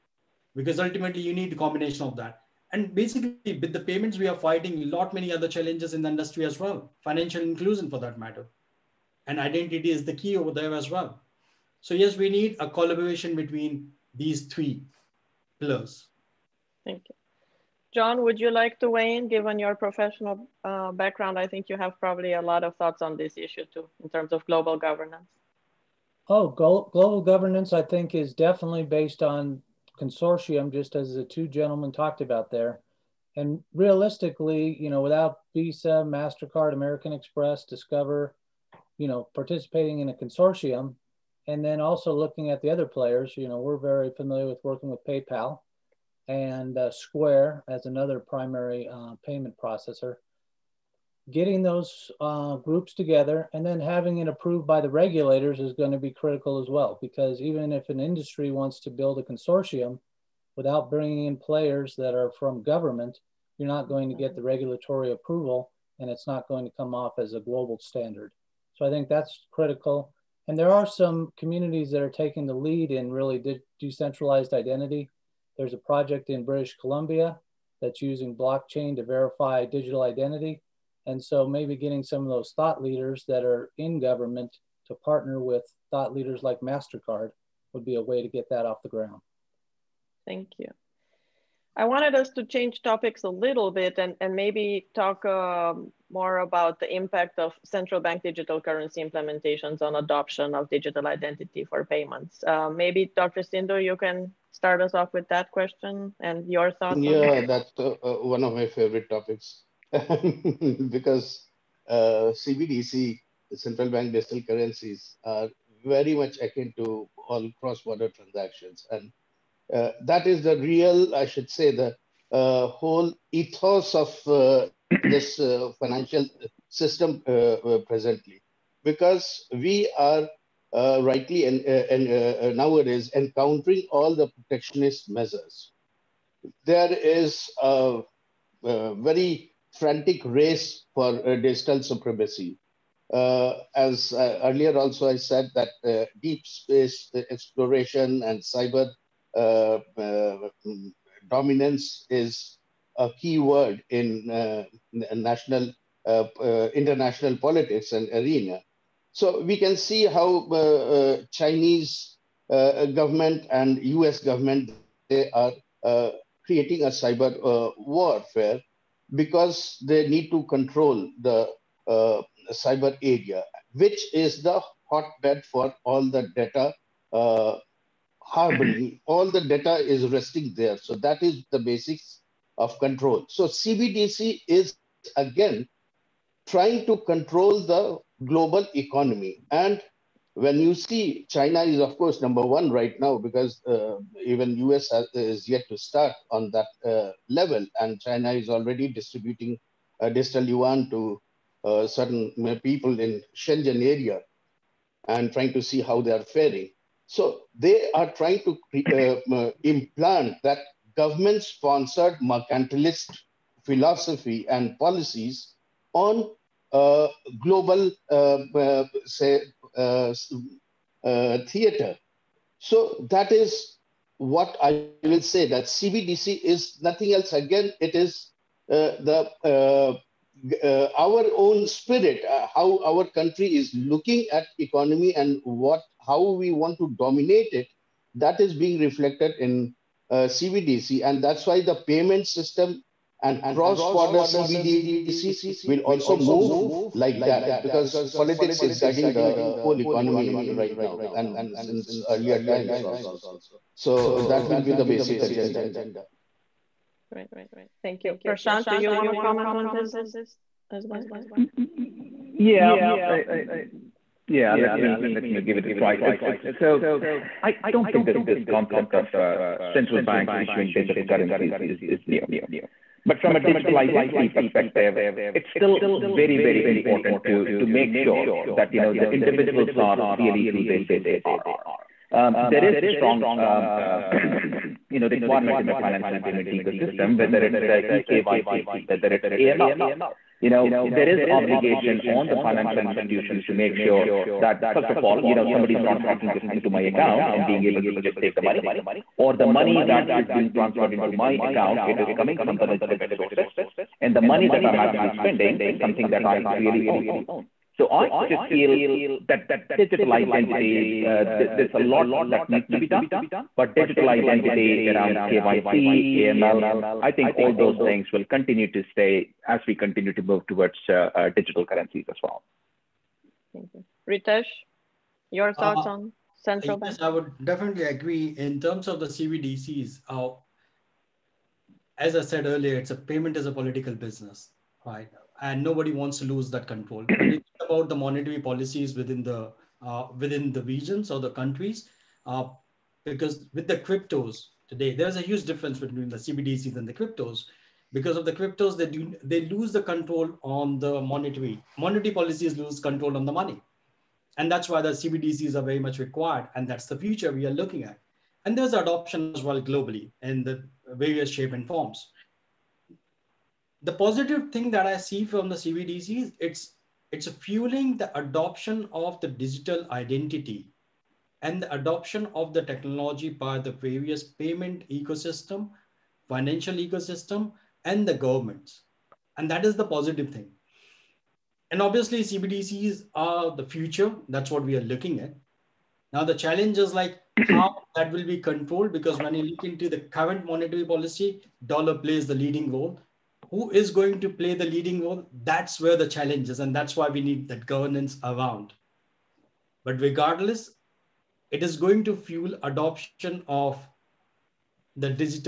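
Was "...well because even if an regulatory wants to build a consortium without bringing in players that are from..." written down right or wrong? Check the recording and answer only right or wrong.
wrong.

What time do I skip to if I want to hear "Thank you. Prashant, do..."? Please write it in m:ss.
4:17.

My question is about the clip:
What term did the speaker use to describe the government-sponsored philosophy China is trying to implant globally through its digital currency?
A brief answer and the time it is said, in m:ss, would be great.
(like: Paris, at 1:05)
mercantilist, at 3:32.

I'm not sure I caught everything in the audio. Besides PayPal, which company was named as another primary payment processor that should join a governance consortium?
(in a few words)
Square.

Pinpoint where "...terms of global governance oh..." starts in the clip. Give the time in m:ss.
0:24.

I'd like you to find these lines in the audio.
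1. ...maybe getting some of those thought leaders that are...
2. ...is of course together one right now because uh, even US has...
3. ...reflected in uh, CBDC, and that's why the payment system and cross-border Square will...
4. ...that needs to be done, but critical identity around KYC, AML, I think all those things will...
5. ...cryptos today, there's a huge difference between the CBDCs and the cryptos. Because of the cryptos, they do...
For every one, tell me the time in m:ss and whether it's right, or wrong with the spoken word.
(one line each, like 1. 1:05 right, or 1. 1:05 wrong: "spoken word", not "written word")
1. 1:21 right
2. 3:11 wrong: "number", not "together"
3. 3:58 wrong: "CBDC", not "Square"
4. 5:12 wrong: "digital", not "critical"
5. 5:43 right.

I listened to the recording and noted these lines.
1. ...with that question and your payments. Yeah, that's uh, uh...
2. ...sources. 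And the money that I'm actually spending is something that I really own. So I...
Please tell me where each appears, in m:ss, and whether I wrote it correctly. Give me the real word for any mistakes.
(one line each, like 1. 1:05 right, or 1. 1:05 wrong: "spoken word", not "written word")
1. 1:45 wrong: "thoughts", not "payments"
2. 5:03 right.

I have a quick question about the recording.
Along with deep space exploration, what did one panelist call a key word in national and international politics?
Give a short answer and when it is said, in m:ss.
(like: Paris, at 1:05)
cyber dominance, at 2:28.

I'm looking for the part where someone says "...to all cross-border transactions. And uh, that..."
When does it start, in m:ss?
1:56.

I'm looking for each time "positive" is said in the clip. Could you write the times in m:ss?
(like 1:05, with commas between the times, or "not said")
6:03, 6:19.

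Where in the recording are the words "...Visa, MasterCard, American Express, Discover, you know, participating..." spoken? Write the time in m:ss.
0:35.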